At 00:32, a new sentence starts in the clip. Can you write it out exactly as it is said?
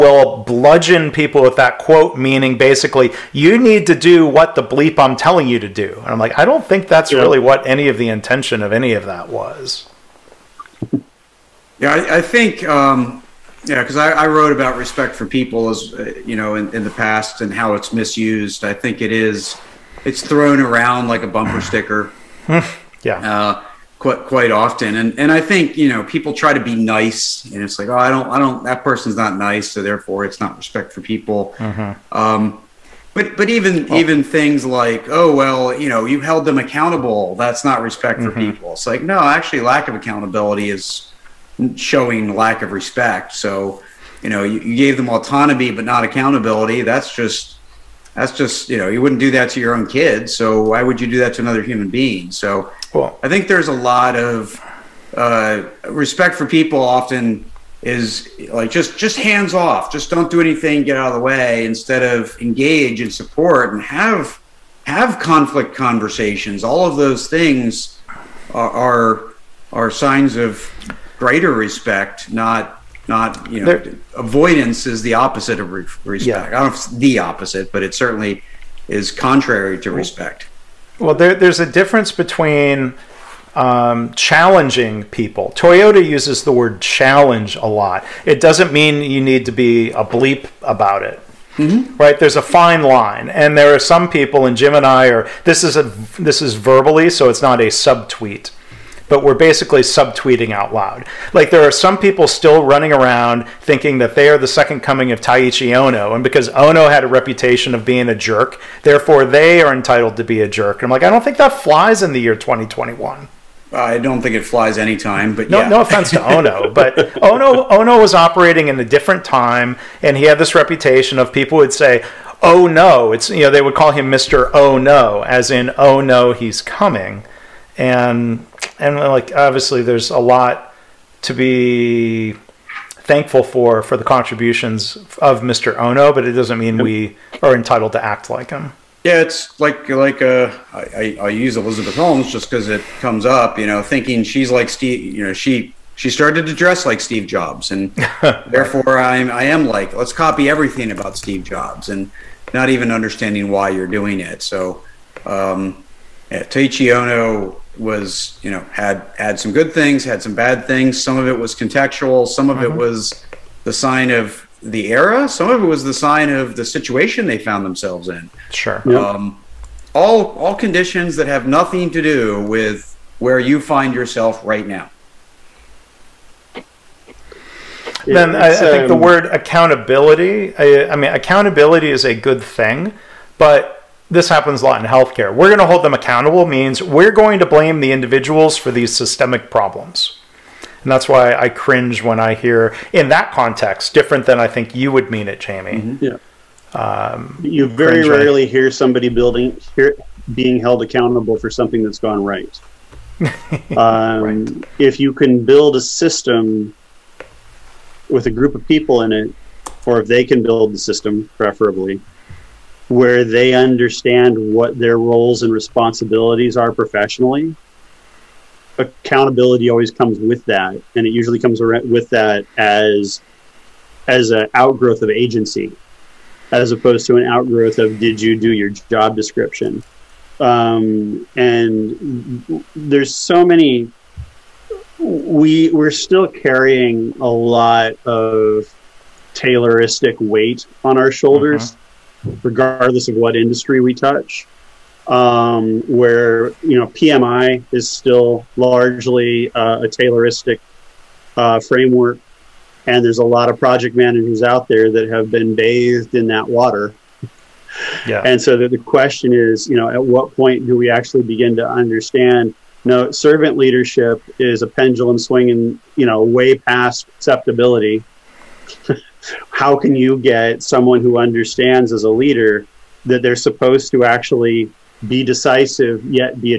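Um, but but even well, even things like oh well you know you held them accountable that's not respect for mm-hmm.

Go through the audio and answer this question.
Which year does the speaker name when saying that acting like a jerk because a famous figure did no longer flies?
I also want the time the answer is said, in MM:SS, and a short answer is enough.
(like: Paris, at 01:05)
2021, at 01:52.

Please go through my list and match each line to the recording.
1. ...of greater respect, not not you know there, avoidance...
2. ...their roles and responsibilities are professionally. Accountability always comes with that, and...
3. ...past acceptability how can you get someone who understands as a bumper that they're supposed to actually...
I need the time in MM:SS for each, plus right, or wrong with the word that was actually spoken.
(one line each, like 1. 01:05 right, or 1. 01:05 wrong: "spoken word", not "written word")
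1. 01:10 right
2. 03:34 right
3. 04:26 wrong: "leader", not "bumper".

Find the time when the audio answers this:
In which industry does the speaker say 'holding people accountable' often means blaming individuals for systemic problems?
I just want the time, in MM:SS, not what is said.
03:04.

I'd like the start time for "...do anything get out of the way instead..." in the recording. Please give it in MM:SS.
01:00.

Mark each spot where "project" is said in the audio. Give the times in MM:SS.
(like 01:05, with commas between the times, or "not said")
04:13.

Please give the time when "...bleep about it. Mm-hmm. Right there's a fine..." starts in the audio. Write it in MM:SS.
01:30.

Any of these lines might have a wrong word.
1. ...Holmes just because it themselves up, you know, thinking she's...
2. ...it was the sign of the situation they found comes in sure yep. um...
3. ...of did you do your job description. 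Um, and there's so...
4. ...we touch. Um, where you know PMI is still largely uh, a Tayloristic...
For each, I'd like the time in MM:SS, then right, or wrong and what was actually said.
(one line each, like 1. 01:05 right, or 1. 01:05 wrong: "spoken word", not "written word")
1. 02:21 wrong: "comes", not "themselves"
2. 02:45 wrong: "themselves", not "comes"
3. 03:47 right
4. 04:03 right.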